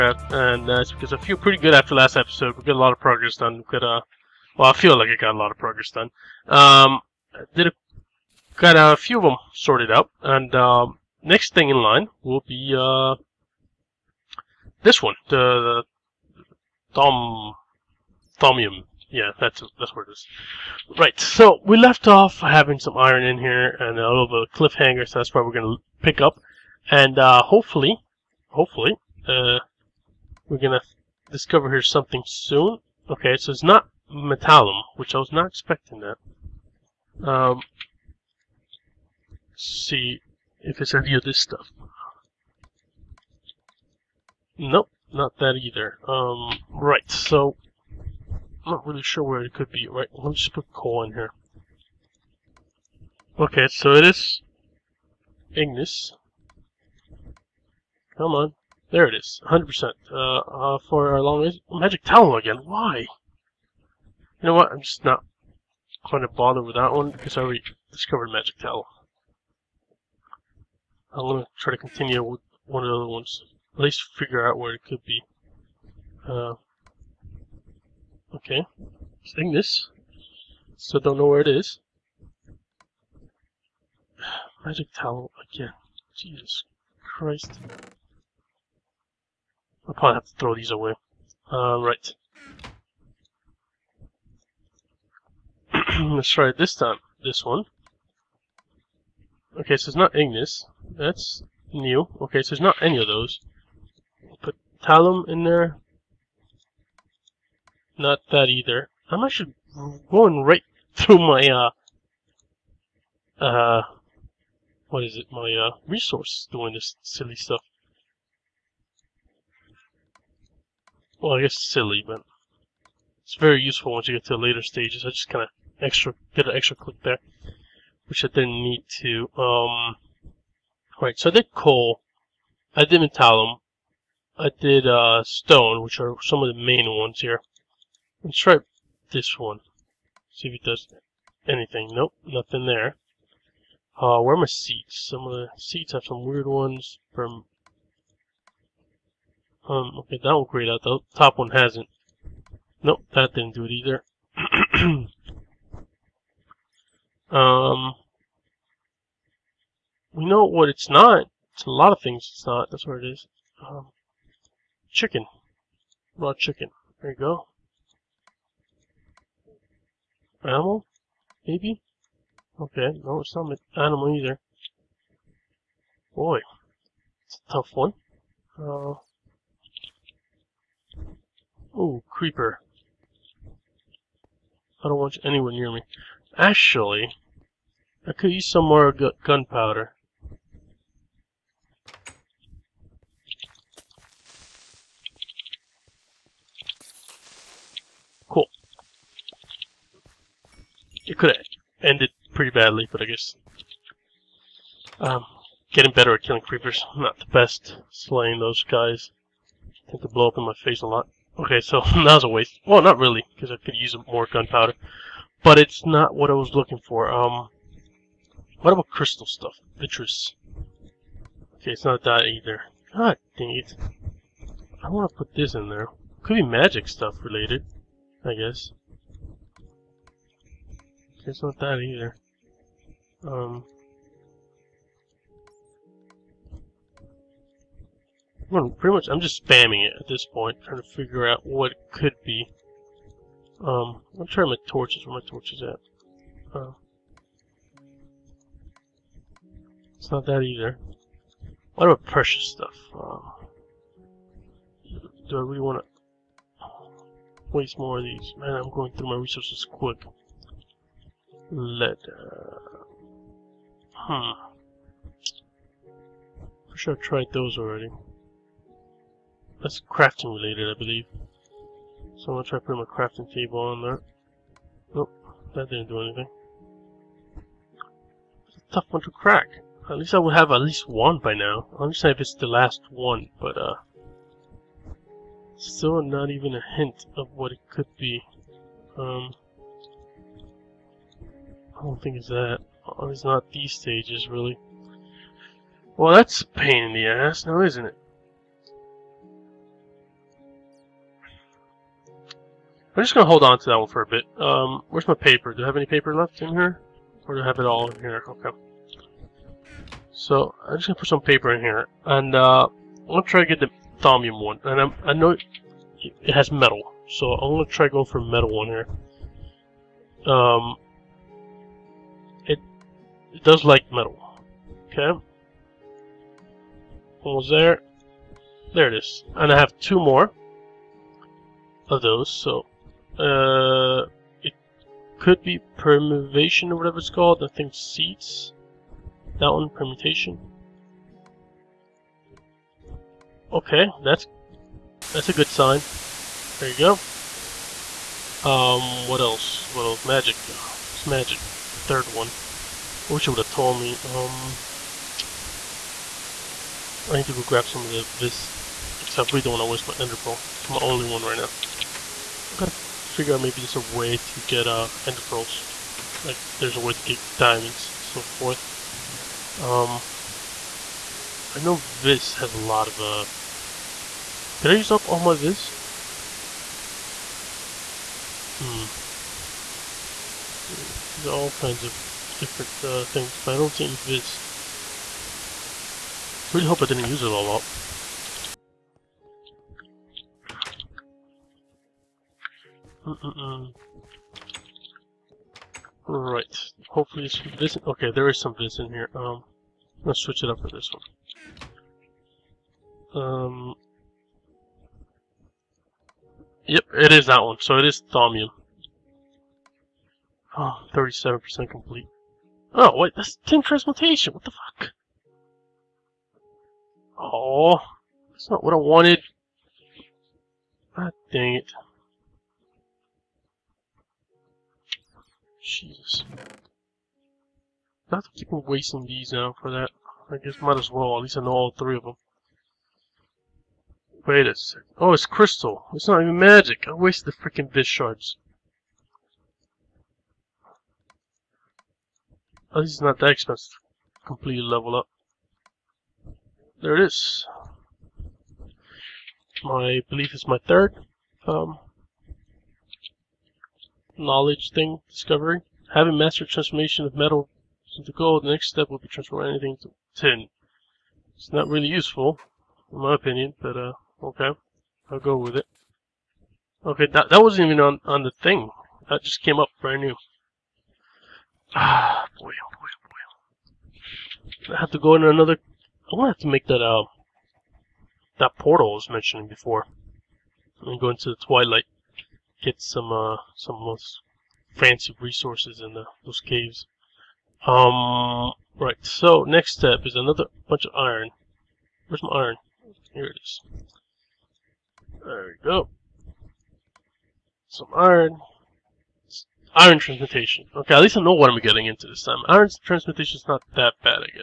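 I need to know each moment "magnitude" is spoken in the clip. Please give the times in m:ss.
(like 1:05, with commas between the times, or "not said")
not said.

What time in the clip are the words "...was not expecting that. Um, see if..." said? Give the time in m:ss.
0:35.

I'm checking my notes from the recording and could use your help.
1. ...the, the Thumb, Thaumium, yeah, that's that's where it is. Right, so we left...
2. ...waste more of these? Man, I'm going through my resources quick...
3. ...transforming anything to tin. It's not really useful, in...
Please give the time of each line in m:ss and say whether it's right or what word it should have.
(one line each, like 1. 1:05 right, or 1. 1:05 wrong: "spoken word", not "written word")
1. 0:15 right
2. 4:17 right
3. 7:39 right.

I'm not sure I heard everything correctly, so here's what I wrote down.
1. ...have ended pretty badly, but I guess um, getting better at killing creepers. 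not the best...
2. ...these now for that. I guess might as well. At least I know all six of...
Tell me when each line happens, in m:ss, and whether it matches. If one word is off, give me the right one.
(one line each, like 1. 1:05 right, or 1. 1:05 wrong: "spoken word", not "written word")
1. 3:21 right
2. 7:09 wrong: "three", not "six".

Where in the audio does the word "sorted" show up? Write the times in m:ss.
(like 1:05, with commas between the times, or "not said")
0:09.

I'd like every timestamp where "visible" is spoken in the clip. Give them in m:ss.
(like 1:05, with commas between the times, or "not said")
not said.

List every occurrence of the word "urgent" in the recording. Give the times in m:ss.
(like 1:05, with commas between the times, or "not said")
not said.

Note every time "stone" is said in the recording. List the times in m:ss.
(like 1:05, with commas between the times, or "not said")
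2:15.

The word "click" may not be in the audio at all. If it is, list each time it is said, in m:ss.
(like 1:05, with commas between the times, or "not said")
2:06.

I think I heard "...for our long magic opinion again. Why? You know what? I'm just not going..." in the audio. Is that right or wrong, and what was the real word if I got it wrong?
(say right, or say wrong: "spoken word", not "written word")
wrong: "talon", not "opinion".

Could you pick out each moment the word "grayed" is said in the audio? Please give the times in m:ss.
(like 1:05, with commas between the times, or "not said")
2:30.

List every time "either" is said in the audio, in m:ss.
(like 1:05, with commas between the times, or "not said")
0:45, 1:48, 2:33, 2:54, 3:42, 3:51, 4:10.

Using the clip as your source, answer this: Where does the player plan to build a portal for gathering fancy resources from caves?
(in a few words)
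the twilight.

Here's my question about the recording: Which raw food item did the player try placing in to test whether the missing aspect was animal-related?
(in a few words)
Raw chicken.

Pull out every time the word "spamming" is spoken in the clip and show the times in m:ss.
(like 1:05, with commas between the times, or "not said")
3:59.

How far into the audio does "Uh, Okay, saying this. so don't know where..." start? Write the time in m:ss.
1:16.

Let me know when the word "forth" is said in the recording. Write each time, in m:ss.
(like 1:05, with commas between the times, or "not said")
6:08.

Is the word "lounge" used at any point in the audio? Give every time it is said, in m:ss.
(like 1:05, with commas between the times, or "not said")
not said.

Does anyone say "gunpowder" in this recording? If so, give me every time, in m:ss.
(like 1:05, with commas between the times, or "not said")
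3:08, 3:34.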